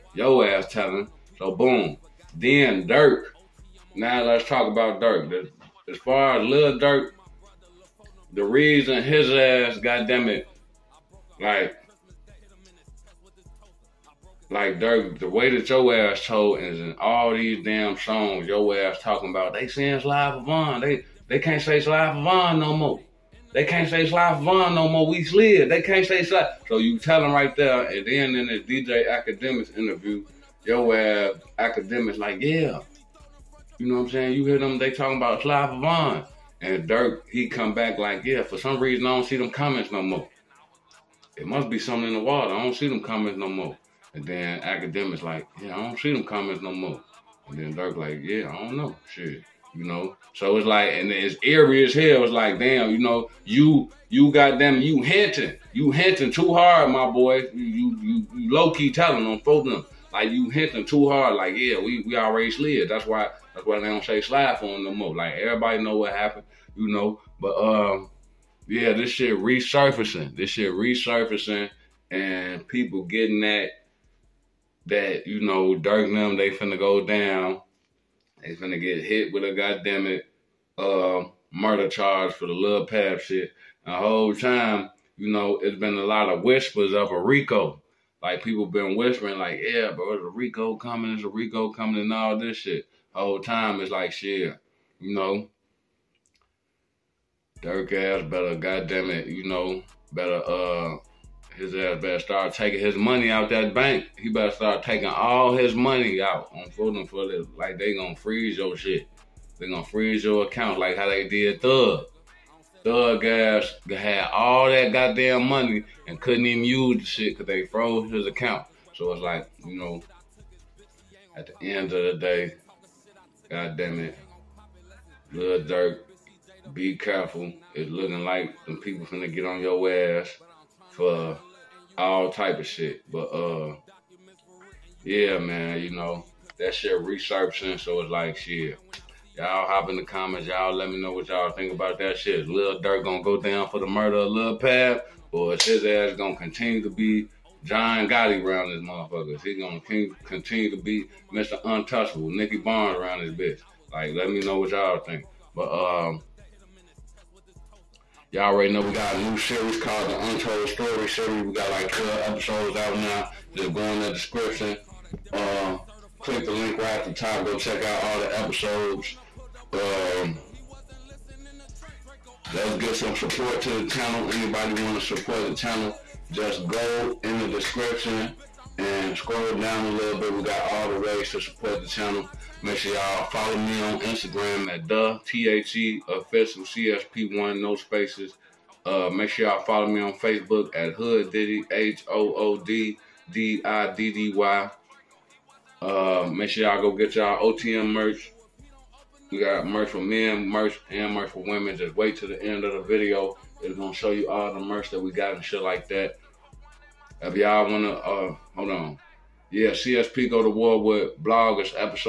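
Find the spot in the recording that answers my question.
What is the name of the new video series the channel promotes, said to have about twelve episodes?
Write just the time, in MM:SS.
02:40.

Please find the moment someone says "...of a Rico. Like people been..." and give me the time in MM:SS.
01:26.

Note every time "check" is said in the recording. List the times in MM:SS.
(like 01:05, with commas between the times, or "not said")
02:47.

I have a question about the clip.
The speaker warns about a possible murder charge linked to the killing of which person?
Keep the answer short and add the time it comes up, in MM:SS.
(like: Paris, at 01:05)
Lil Pab, at 02:24.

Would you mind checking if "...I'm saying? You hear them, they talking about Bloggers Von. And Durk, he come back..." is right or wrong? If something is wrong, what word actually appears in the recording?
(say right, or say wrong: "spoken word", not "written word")
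wrong: "Clive", not "Bloggers".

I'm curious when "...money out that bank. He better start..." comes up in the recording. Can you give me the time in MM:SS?
01:42.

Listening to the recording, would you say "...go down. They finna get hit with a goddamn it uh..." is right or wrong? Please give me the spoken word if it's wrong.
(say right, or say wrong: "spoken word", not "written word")
right.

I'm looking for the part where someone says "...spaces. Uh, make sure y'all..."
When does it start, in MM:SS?
03:07.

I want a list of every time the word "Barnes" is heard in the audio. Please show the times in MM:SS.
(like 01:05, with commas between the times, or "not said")
02:32.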